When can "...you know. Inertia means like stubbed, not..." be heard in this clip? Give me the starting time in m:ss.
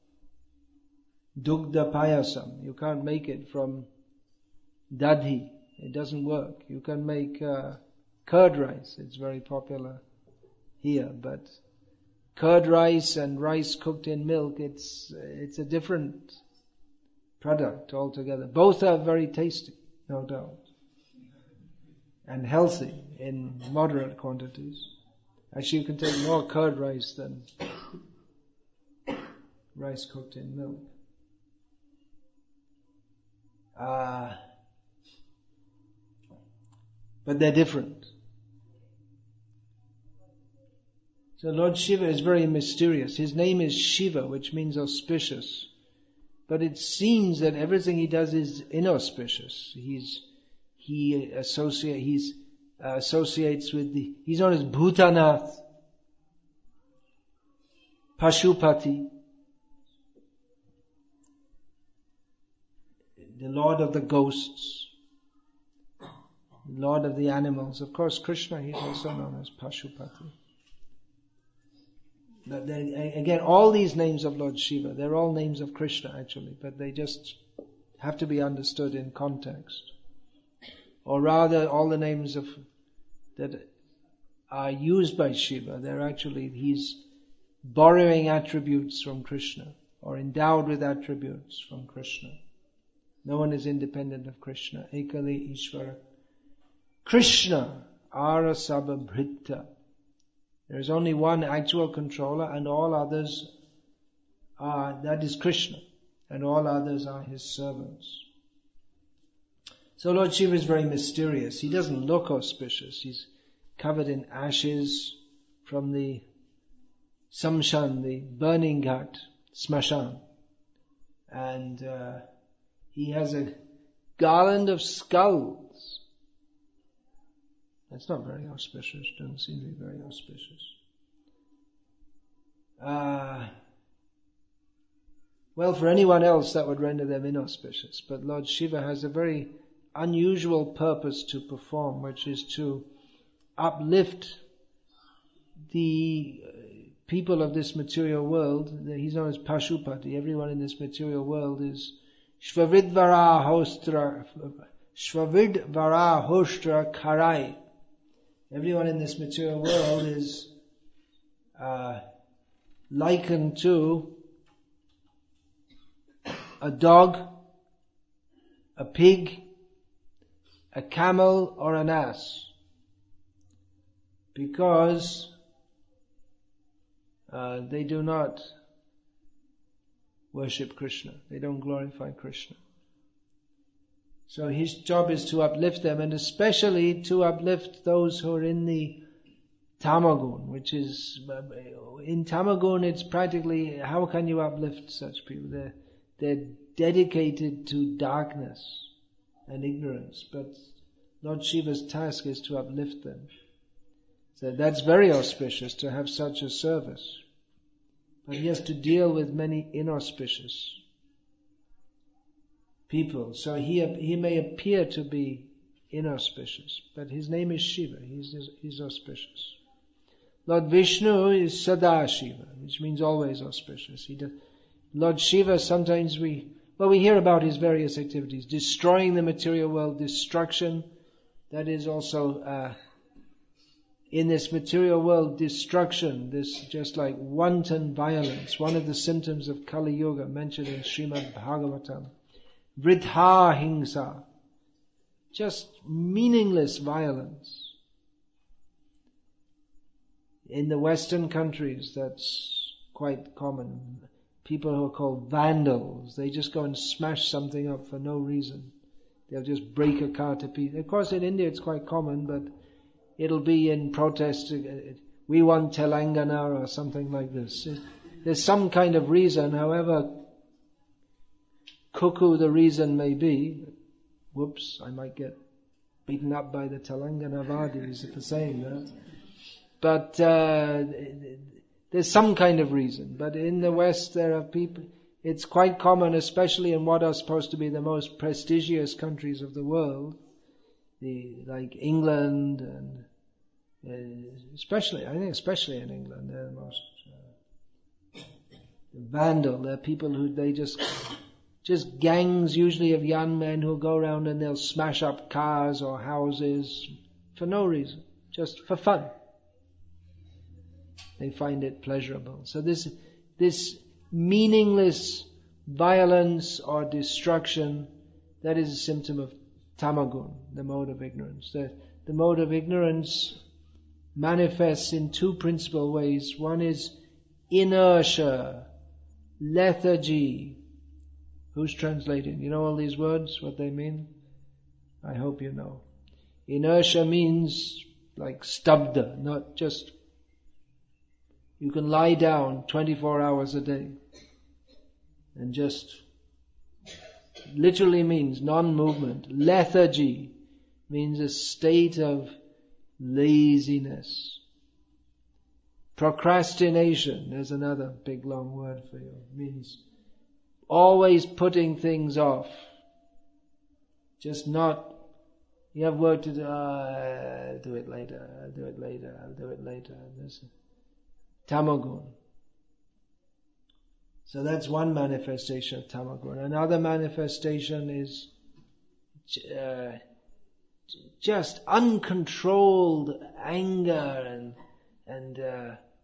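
5:35.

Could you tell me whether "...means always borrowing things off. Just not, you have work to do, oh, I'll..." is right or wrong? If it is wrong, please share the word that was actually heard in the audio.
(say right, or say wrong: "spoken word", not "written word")
wrong: "putting", not "borrowing".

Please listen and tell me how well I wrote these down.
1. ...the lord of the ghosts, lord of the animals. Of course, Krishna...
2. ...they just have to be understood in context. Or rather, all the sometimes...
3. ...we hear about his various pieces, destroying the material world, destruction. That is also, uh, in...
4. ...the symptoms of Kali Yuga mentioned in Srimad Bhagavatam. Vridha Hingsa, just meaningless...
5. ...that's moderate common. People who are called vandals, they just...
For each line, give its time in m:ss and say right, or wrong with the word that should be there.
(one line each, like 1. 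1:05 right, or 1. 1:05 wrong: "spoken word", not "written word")
1. 1:03 right
2. 1:16 wrong: "names", not "sometimes"
3. 3:46 wrong: "activities", not "pieces"
4. 3:58 right
5. 4:11 wrong: "quite", not "moderate".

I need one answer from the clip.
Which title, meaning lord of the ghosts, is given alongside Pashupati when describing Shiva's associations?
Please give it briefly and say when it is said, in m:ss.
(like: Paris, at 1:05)
Bhutanath, at 0:54.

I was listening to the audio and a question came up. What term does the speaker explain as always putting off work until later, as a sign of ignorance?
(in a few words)
Procrastination.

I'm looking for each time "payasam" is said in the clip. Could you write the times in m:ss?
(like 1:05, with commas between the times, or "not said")
0:01.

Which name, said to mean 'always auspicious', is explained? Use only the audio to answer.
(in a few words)
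Sadashiva.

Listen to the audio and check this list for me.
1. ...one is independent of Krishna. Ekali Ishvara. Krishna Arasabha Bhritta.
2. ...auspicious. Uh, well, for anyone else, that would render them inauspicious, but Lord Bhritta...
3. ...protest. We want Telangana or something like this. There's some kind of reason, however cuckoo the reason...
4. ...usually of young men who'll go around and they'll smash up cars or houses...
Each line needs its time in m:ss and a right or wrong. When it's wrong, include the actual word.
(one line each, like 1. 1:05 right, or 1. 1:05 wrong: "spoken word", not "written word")
1. 1:33 right
2. 2:10 wrong: "Shiva", not "Bhritta"
3. 4:23 right
4. 5:02 right.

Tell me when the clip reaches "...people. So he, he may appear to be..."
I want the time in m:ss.
3:32.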